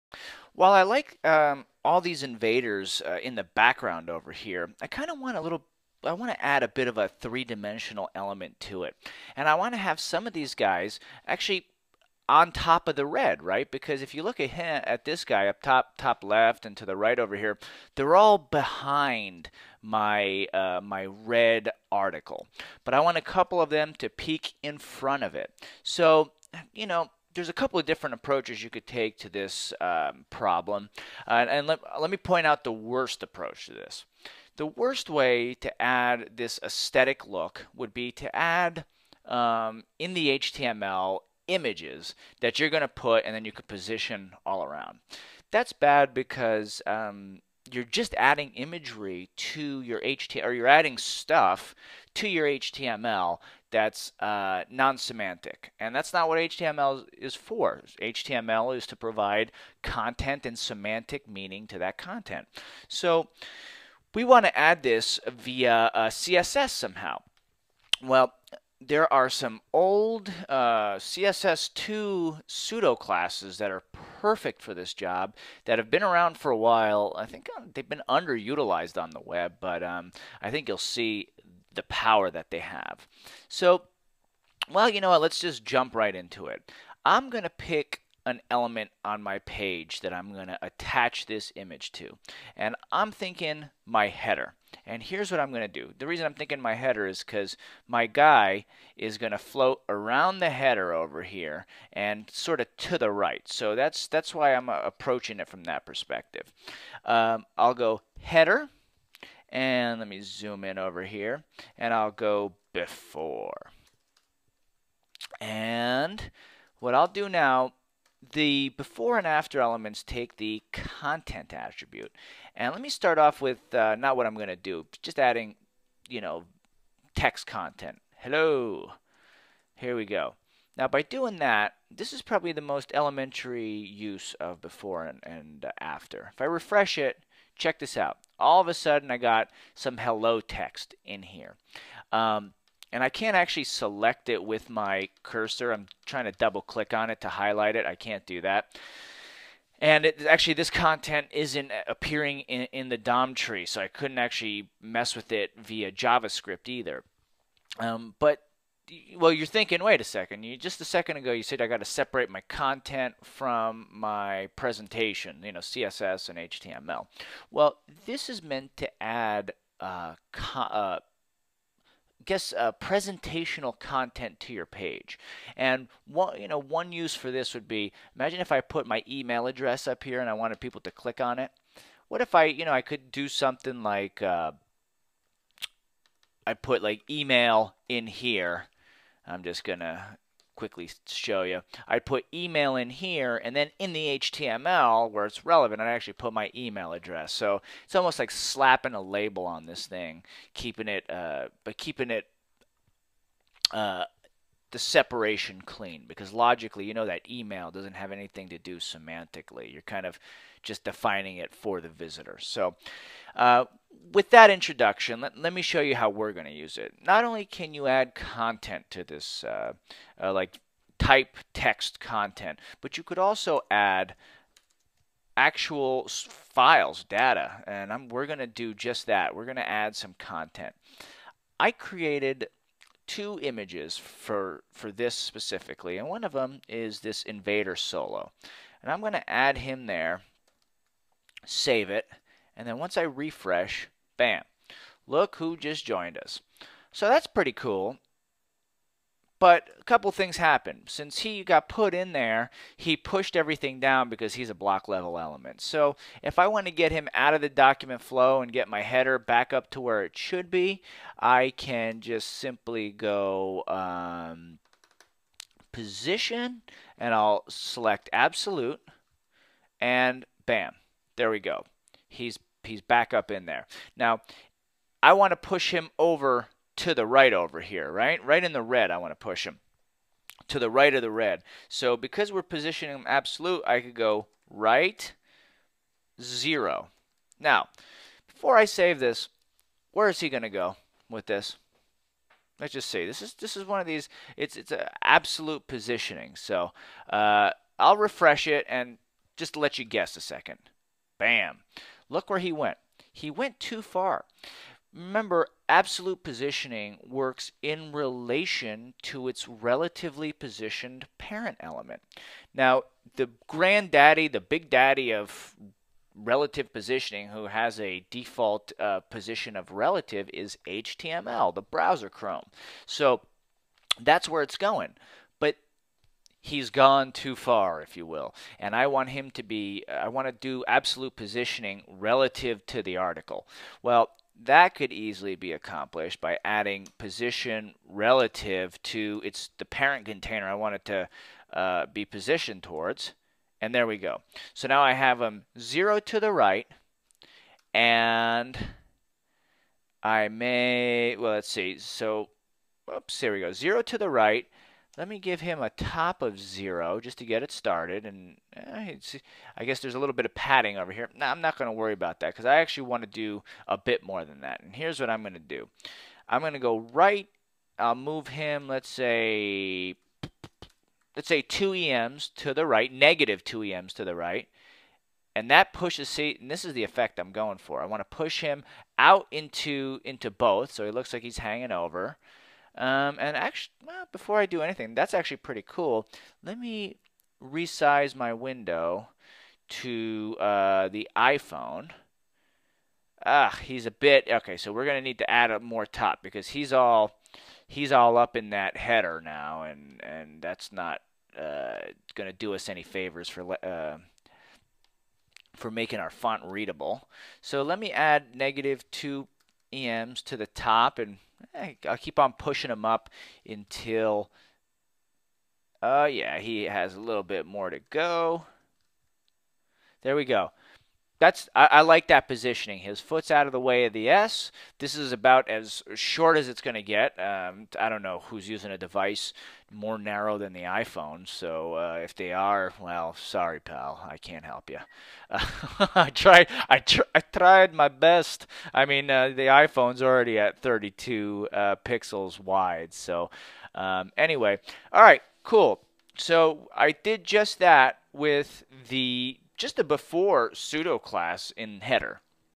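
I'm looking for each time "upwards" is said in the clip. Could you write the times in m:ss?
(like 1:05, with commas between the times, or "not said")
not said.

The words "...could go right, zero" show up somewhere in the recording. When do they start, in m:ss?
4:43.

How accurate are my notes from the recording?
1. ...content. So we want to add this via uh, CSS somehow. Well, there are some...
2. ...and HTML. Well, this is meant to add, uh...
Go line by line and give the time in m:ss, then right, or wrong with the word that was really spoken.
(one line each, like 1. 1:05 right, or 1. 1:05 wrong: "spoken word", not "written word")
1. 1:01 right
2. 2:46 right.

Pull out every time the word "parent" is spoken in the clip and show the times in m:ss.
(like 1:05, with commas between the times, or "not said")
5:11, 5:39.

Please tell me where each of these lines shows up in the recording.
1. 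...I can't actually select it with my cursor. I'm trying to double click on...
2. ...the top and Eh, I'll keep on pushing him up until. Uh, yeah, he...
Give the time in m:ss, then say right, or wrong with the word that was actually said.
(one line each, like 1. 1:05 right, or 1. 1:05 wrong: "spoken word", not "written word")
1. 2:23 right
2. 6:50 right.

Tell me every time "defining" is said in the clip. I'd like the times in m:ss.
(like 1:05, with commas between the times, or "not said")
3:30.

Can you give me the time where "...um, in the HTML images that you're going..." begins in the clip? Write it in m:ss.
0:39.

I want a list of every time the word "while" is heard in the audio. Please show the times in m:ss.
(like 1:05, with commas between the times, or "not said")
0:00, 1:16.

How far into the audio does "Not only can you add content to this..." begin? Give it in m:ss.
3:37.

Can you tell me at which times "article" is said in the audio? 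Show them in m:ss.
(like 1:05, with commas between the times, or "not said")
0:21, 5:32.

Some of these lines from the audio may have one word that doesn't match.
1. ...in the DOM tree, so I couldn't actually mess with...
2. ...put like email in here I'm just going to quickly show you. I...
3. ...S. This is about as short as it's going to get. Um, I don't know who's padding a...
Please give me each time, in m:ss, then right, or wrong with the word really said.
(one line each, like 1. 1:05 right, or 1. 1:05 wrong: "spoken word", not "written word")
1. 2:32 right
2. 3:06 right
3. 7:04 wrong: "using", not "padding".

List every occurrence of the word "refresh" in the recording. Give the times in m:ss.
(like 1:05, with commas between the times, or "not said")
2:16, 4:03, 4:57.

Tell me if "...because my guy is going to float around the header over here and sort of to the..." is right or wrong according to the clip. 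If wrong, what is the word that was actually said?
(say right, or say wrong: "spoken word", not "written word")
right.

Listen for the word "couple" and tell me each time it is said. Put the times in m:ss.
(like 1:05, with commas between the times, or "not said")
0:23, 0:27, 4:09.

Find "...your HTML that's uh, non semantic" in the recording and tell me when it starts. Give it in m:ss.
0:52.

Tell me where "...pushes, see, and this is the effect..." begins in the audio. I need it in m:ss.
6:15.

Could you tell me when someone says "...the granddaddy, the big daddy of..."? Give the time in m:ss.
5:13.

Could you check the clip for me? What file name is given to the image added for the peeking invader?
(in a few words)
invader solo.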